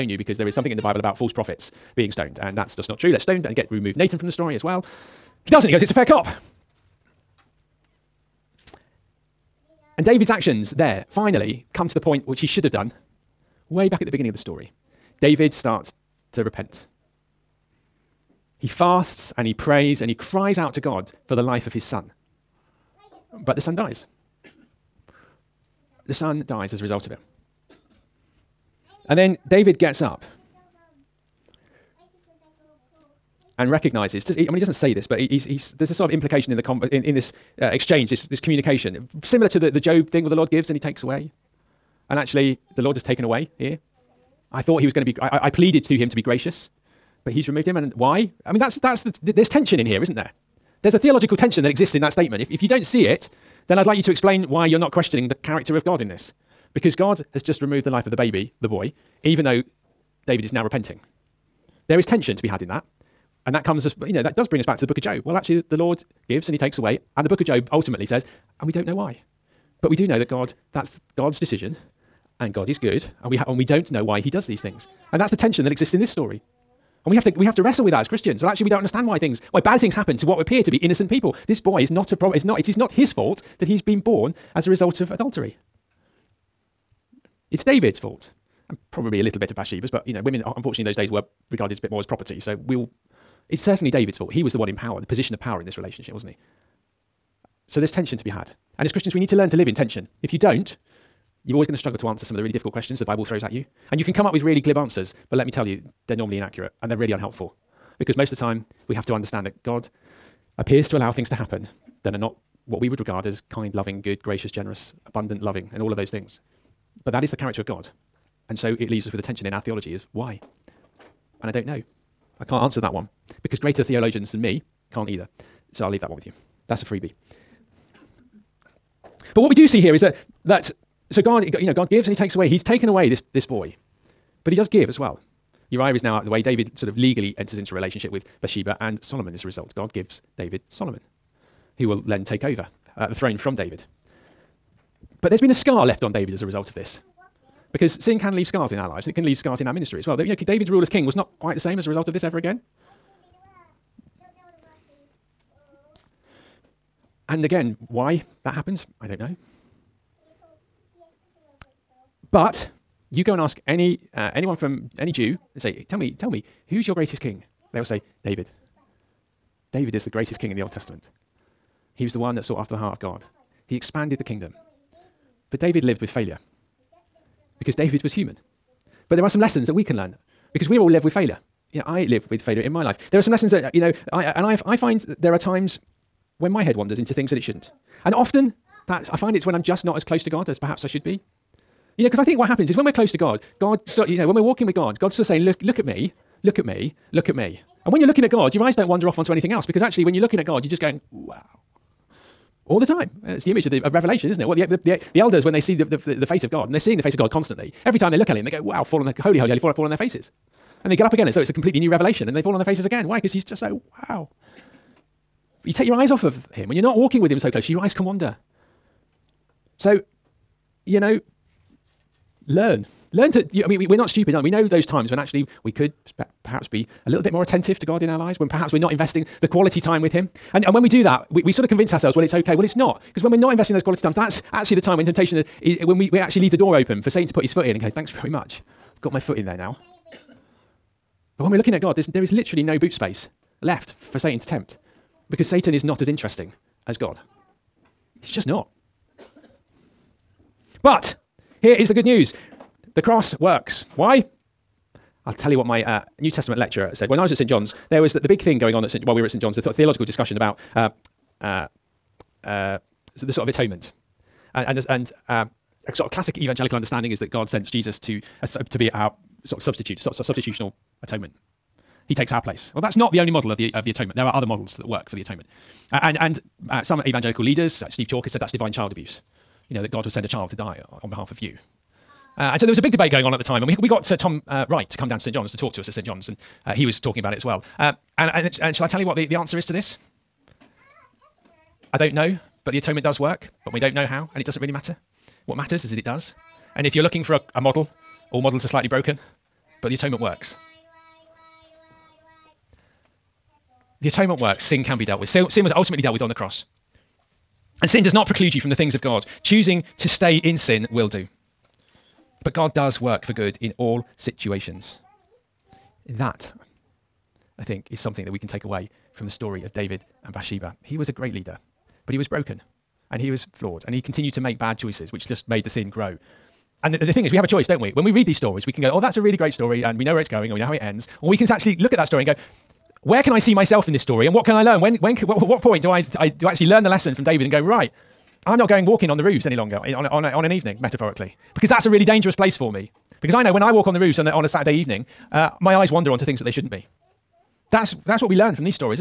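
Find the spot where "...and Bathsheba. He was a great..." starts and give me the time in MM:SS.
05:20.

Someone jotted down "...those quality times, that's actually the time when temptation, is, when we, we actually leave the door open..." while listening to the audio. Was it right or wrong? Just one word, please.
right.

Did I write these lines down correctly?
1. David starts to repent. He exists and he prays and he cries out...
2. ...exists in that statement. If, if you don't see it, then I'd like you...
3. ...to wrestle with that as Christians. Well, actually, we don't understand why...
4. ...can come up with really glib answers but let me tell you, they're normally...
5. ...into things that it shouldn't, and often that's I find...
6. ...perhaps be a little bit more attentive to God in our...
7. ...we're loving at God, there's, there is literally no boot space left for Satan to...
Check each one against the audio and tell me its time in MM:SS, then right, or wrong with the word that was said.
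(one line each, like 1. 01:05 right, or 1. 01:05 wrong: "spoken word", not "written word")
1. 00:15 wrong: "fasts", not "exists"
2. 00:51 right
3. 01:17 right
4. 01:44 right
5. 03:06 right
6. 03:46 right
7. 04:01 wrong: "looking", not "loving".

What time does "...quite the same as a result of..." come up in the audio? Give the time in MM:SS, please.
02:31.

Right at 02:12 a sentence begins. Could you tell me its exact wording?
He's taken away this this boy, but He does give as well.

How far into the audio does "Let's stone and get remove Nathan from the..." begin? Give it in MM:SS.
00:03.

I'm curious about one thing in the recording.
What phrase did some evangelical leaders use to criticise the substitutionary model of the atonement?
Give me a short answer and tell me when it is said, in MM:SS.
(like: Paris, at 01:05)
divine child abuse, at 04:38.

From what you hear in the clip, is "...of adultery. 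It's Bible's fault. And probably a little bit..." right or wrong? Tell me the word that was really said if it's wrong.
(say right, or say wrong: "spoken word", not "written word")
wrong: "David", not "Bible".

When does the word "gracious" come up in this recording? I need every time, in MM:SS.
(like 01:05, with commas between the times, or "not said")
00:46, 01:54.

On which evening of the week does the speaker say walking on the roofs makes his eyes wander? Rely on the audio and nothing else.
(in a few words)
Saturday.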